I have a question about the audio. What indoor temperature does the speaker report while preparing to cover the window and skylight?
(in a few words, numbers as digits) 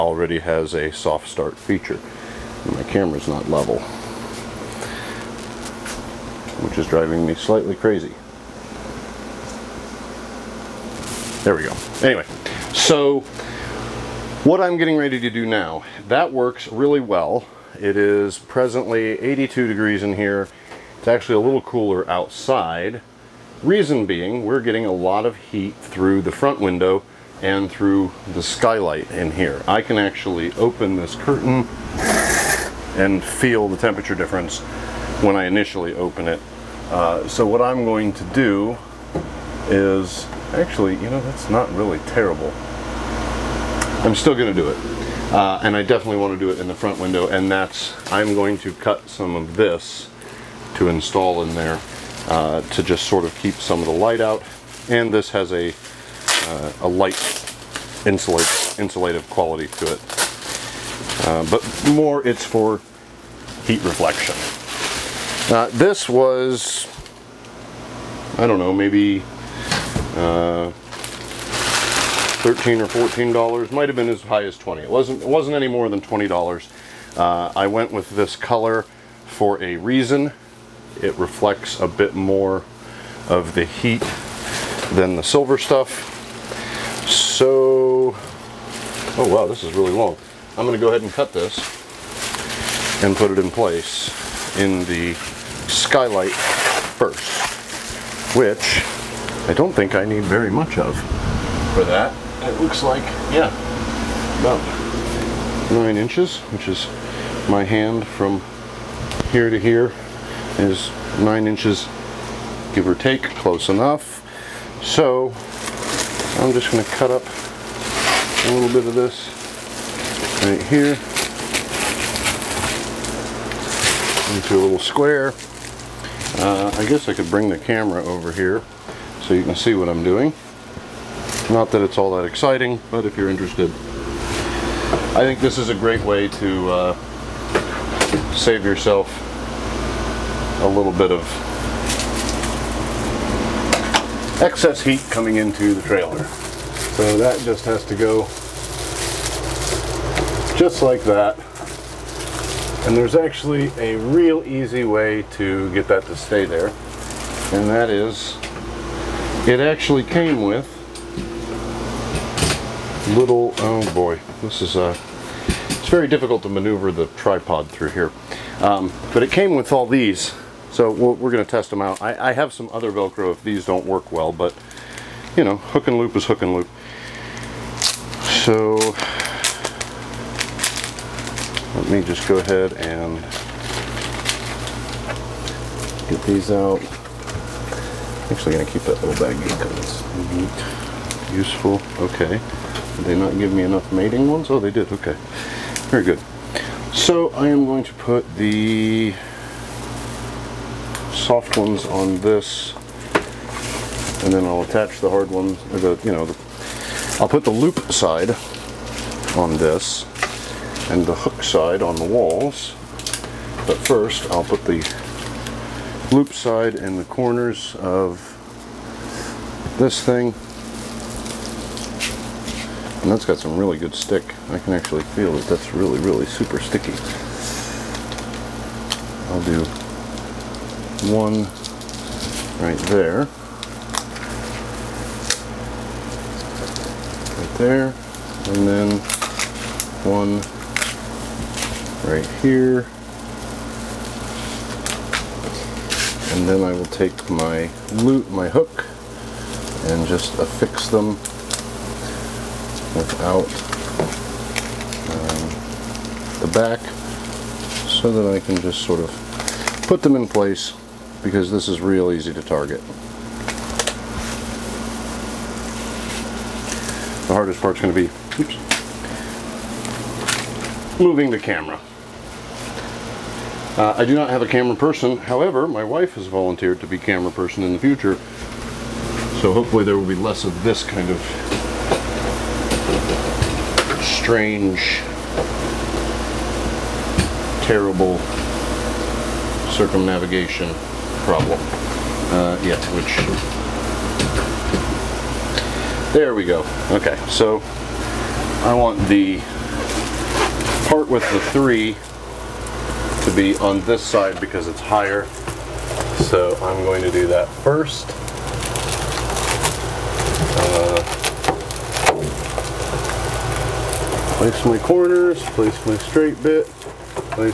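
82 degrees.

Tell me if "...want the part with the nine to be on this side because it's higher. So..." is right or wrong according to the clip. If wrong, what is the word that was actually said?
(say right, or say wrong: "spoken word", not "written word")
wrong: "three", not "nine".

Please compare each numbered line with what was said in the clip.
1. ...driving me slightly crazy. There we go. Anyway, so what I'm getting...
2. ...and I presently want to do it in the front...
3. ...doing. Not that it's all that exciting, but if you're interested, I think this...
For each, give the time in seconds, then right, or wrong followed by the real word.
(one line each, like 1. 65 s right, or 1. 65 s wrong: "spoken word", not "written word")
1. 6 s right
2. 45 s wrong: "definitely", not "presently"
3. 130 s right.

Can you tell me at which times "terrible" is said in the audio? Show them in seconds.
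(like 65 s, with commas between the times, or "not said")
42 s, 287 s.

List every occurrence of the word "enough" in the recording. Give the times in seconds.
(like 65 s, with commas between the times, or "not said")
113 s, 193 s.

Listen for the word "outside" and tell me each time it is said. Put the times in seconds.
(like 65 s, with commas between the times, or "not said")
22 s.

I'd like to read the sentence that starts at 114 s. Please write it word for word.
So I'm just going to cut up a little bit of this right here into a little square.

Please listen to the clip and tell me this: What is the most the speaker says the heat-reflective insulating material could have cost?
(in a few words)
$20.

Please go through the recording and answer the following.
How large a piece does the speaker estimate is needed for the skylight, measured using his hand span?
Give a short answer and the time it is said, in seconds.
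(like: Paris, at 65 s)
9 inches, at 104 s.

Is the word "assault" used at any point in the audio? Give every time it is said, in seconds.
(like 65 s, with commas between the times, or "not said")
not said.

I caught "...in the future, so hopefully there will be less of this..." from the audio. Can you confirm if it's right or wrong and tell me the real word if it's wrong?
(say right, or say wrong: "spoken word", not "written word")
right.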